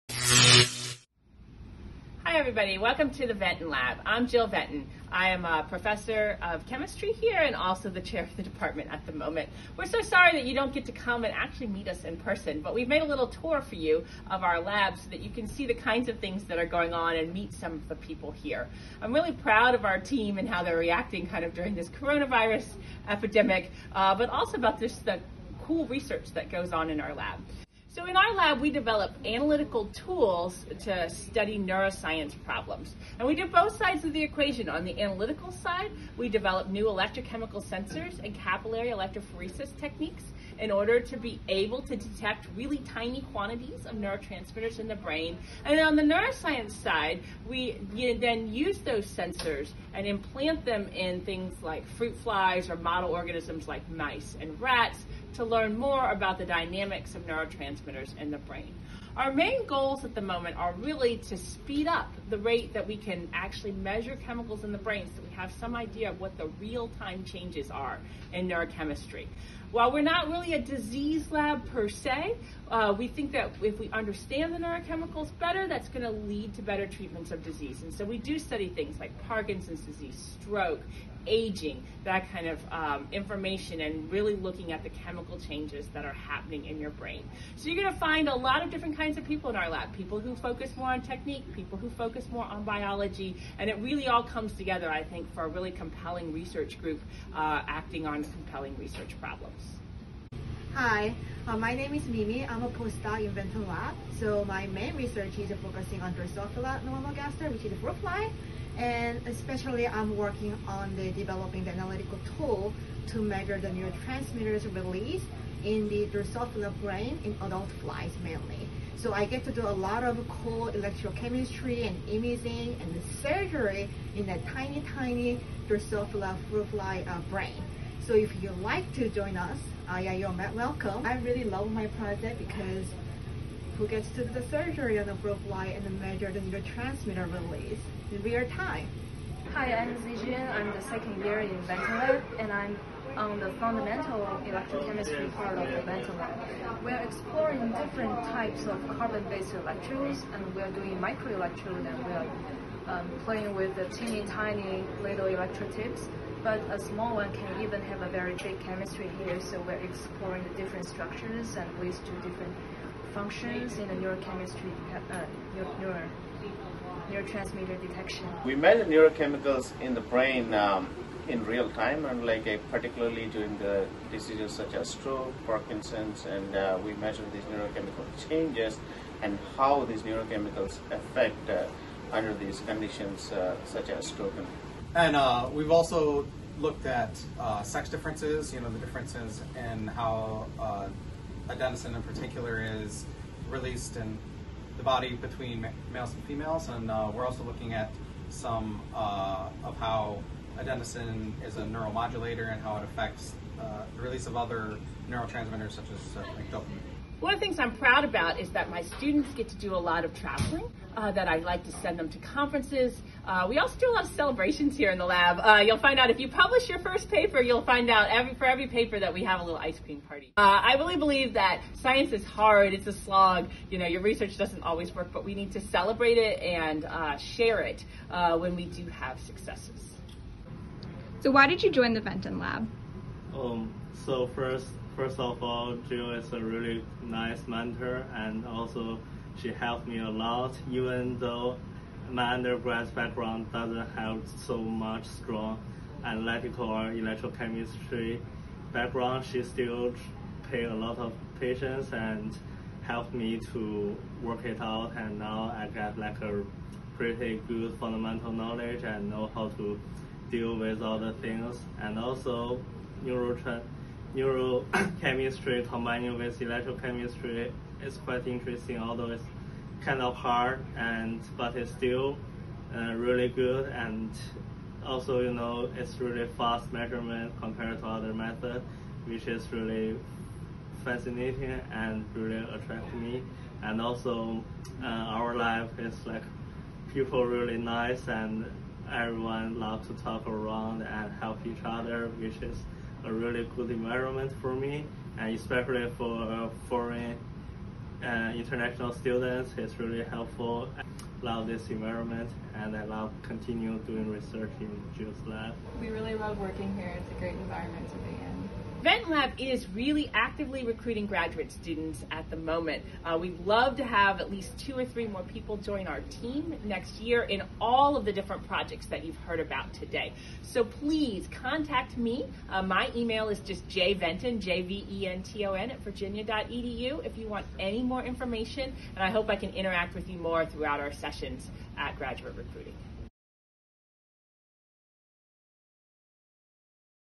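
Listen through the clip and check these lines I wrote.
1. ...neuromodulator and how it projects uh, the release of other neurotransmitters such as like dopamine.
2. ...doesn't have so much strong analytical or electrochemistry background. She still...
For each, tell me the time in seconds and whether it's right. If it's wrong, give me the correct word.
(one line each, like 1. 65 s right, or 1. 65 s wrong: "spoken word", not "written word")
1. 201 s wrong: "affects", not "projects"
2. 243 s right.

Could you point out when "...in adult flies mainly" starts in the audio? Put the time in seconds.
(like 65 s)
117 s.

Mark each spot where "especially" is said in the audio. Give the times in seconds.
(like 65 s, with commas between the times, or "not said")
109 s, 295 s.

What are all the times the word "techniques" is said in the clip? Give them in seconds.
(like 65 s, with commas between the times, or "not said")
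39 s, 91 s.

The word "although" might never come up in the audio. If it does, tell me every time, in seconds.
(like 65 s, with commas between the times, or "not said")
268 s.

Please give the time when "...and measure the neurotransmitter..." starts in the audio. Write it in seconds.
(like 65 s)
135 s.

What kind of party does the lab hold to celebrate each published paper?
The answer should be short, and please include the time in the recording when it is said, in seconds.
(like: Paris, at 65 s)
ice cream party, at 219 s.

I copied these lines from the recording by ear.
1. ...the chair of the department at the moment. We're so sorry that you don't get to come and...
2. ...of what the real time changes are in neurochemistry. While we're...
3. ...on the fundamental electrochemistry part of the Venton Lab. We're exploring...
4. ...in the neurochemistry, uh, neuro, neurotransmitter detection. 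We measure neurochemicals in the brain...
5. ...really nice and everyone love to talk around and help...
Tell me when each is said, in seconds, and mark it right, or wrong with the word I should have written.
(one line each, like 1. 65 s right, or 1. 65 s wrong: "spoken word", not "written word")
1. 7 s right
2. 66 s right
3. 143 s right
4. 163 s right
5. 287 s right.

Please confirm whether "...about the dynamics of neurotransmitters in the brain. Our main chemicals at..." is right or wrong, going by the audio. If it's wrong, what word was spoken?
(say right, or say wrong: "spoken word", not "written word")
wrong: "goals", not "chemicals".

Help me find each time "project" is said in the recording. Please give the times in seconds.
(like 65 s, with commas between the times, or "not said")
131 s, 318 s.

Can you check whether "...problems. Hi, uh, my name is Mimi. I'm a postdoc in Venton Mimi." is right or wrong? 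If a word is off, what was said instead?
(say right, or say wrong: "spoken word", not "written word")
wrong: "Lab", not "Mimi".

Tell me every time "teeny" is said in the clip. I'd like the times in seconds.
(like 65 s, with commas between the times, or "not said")
153 s.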